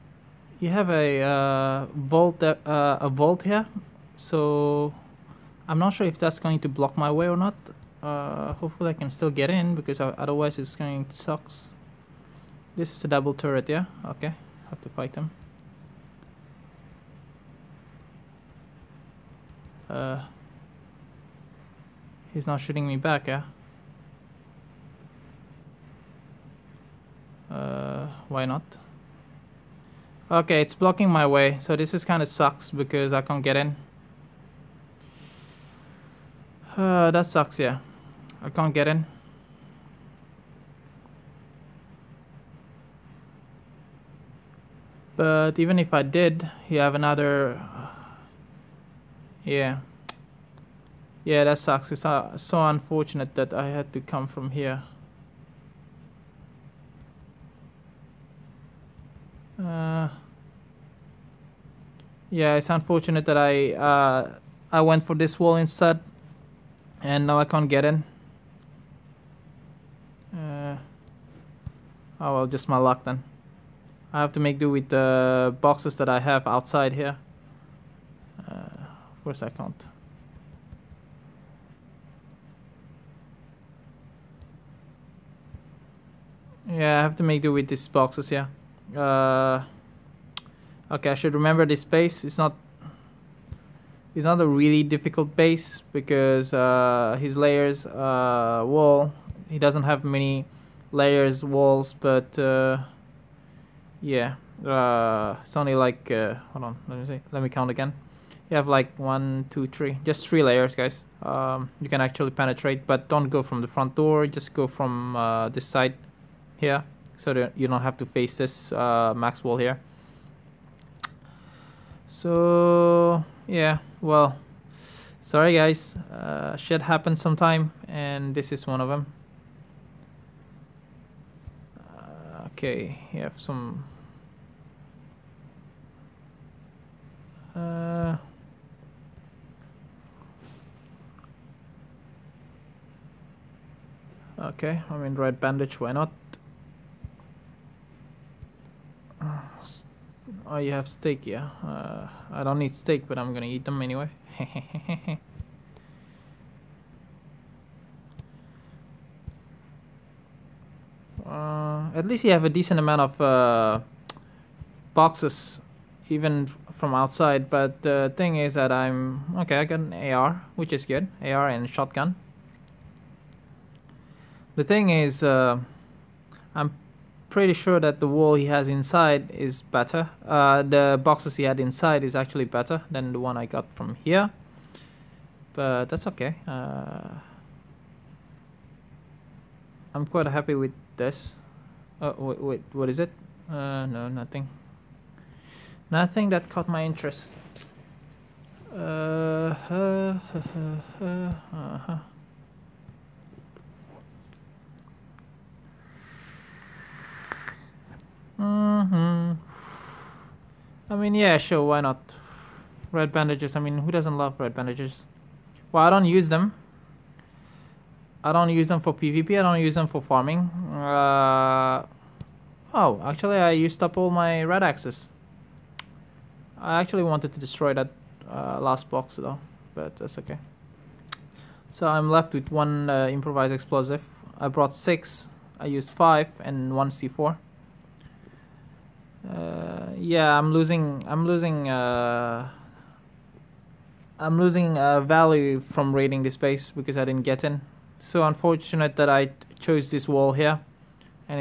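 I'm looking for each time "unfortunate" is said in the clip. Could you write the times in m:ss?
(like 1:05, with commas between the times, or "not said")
0:52, 1:02, 4:08.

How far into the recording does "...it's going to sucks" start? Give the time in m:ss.
0:10.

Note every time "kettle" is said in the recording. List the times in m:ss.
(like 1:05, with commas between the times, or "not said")
not said.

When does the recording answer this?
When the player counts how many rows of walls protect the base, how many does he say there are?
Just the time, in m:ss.
1:50.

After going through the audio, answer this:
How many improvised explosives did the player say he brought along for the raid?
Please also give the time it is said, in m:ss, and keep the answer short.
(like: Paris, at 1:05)
6, at 3:54.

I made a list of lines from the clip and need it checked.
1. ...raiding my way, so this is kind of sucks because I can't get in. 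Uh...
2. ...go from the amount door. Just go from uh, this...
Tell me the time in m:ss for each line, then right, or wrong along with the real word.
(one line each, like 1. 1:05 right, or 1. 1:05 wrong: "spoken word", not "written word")
1. 0:30 wrong: "blocking", not "raiding"
2. 1:53 wrong: "front", not "amount".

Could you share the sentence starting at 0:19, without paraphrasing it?
Uh, he's not shooting me back, yeah.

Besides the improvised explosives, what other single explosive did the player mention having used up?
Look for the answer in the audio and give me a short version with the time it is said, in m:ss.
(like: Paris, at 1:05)
C4, at 3:56.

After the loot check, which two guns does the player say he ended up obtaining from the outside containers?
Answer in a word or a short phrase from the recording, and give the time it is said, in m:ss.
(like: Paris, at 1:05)
AR and shotgun, at 2:51.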